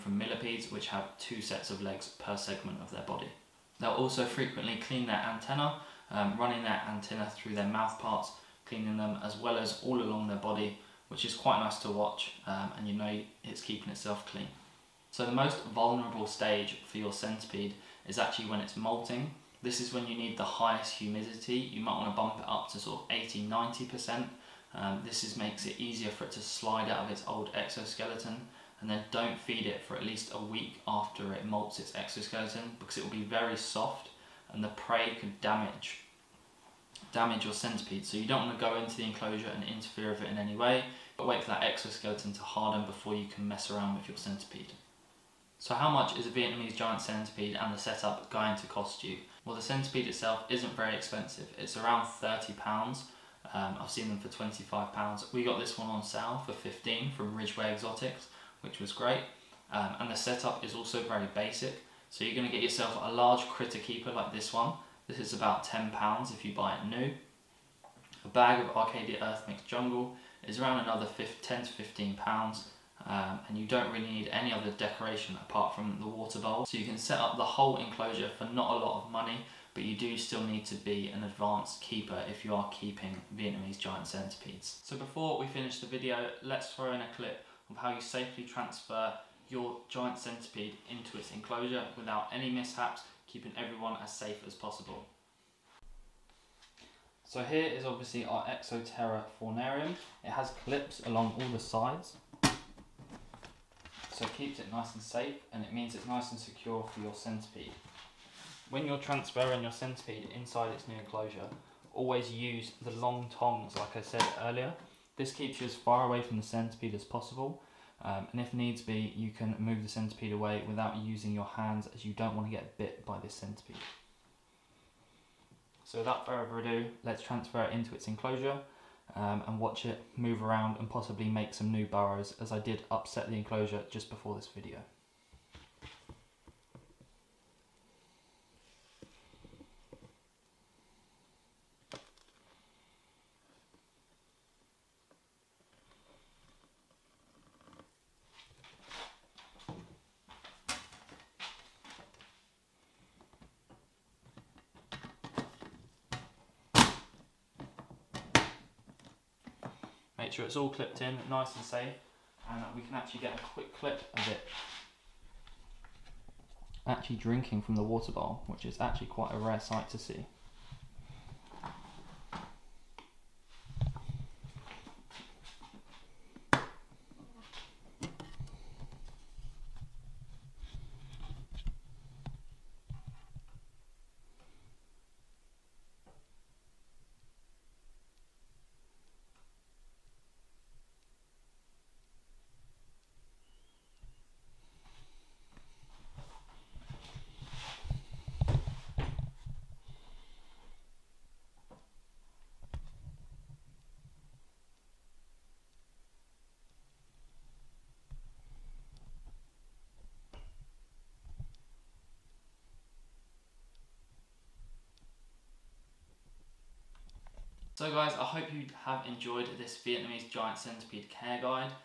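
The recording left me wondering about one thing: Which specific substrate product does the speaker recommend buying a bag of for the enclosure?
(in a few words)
Arcadia Earth Mix Jungle.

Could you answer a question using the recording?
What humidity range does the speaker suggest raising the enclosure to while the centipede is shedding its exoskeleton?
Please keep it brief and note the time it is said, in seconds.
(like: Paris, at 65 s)
80-90%, at 23 s.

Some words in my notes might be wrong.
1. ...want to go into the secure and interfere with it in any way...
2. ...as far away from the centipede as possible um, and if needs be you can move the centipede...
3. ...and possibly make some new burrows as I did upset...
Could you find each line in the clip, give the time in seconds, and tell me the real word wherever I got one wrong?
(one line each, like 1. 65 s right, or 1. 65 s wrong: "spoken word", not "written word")
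1. 38 s wrong: "enclosure", not "secure"
2. 115 s right
3. 130 s right.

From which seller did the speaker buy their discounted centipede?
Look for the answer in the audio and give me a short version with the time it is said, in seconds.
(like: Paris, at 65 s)
Ridgeway Exotics, at 57 s.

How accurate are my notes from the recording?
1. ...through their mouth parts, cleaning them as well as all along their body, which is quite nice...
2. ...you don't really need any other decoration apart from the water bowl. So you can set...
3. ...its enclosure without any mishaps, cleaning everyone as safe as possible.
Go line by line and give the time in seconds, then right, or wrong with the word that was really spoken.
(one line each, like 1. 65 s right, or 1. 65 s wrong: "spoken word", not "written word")
1. 7 s right
2. 73 s right
3. 91 s wrong: "keeping", not "cleaning".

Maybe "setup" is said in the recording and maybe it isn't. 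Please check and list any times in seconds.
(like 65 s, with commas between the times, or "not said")
47 s, 60 s.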